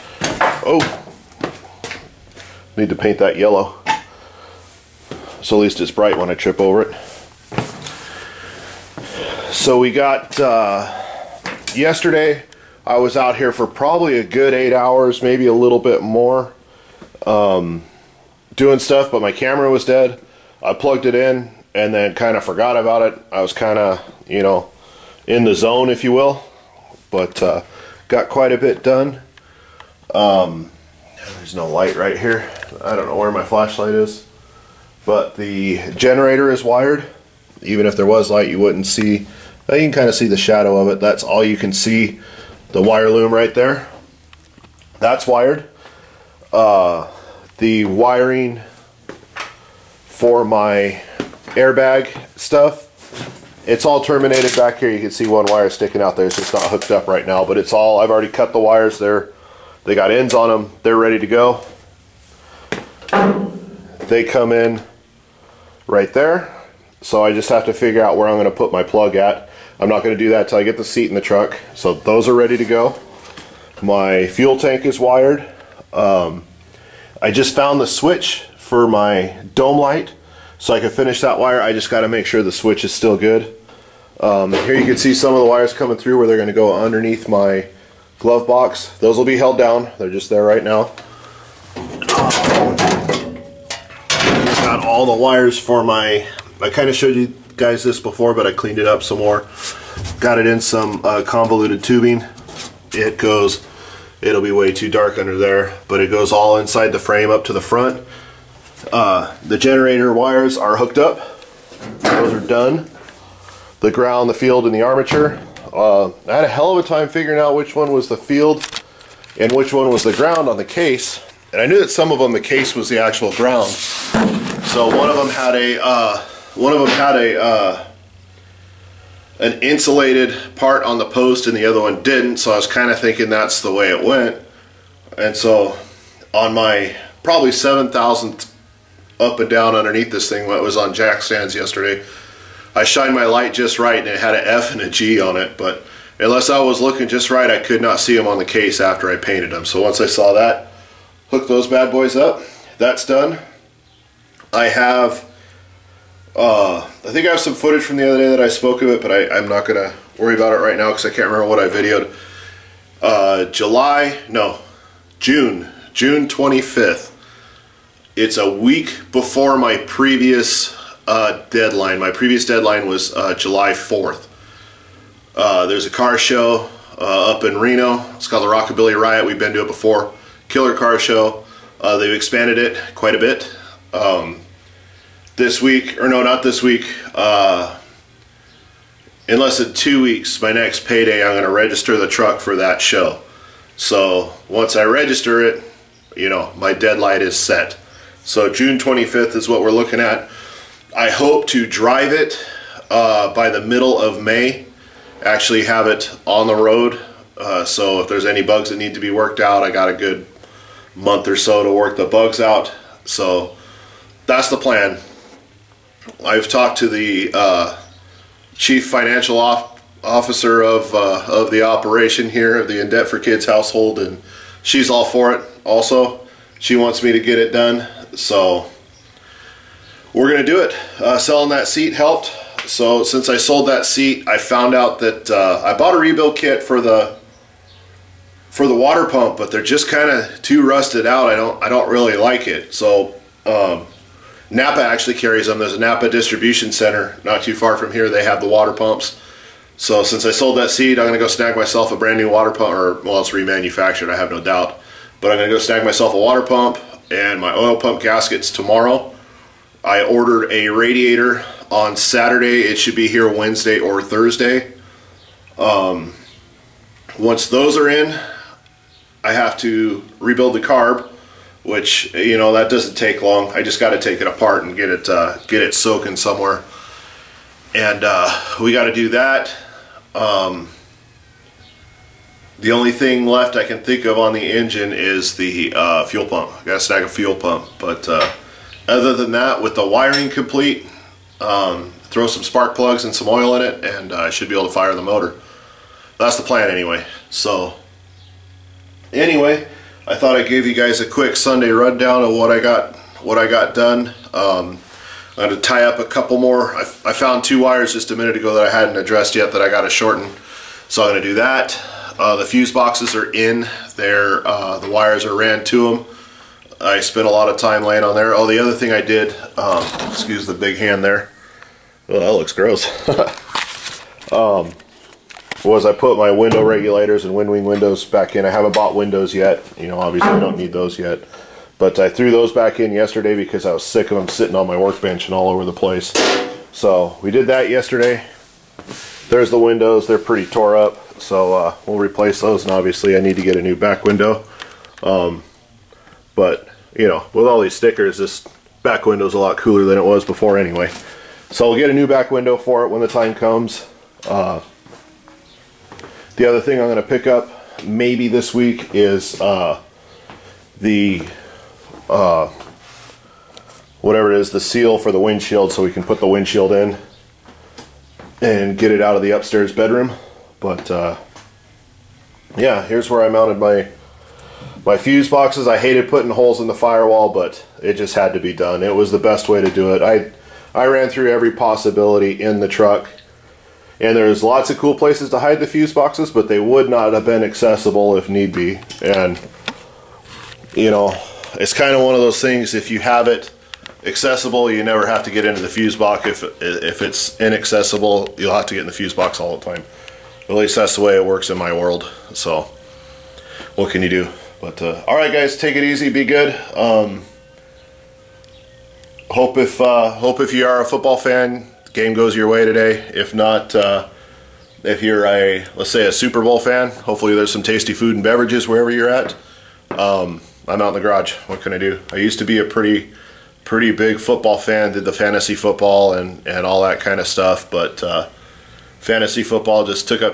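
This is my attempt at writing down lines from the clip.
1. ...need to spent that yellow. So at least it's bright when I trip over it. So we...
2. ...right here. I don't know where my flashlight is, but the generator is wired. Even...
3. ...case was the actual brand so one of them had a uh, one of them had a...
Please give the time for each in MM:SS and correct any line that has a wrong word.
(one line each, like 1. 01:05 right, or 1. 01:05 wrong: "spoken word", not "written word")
1. 00:02 wrong: "paint", not "spent"
2. 00:31 right
3. 02:02 wrong: "ground", not "brand".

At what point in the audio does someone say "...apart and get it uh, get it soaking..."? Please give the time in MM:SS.
04:34.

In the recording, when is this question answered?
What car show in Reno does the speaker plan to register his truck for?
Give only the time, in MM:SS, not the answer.
02:58.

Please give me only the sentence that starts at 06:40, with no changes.
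At least that's the way it works in my world.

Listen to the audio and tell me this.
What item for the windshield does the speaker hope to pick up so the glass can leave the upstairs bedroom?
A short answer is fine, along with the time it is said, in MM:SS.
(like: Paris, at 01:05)
seal, at 06:04.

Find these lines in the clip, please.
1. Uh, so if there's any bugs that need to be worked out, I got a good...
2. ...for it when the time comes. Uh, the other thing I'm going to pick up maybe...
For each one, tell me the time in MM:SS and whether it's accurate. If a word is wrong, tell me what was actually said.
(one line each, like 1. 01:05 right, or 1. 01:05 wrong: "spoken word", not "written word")
1. 03:27 right
2. 05:52 right.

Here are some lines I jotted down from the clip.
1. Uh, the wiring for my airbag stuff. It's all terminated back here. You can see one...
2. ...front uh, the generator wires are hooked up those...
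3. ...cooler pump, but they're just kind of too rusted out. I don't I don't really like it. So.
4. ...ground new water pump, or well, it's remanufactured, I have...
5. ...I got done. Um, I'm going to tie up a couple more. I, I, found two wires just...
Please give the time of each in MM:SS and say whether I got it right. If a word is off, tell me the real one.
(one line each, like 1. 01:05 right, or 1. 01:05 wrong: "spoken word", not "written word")
1. 00:46 right
2. 01:47 right
3. 03:58 wrong: "water", not "cooler"
4. 04:11 wrong: "brand", not "ground"
5. 05:03 right.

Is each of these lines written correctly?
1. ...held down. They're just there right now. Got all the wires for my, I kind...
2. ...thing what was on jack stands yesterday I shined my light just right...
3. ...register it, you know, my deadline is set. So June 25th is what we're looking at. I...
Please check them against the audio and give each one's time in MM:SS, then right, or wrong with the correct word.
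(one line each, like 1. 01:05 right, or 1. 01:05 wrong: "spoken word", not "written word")
1. 01:29 right
2. 02:20 right
3. 03:14 right.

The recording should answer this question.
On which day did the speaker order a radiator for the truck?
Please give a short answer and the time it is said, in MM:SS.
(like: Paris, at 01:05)
Saturday, at 04:21.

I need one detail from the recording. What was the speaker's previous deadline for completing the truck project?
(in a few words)
July 4th.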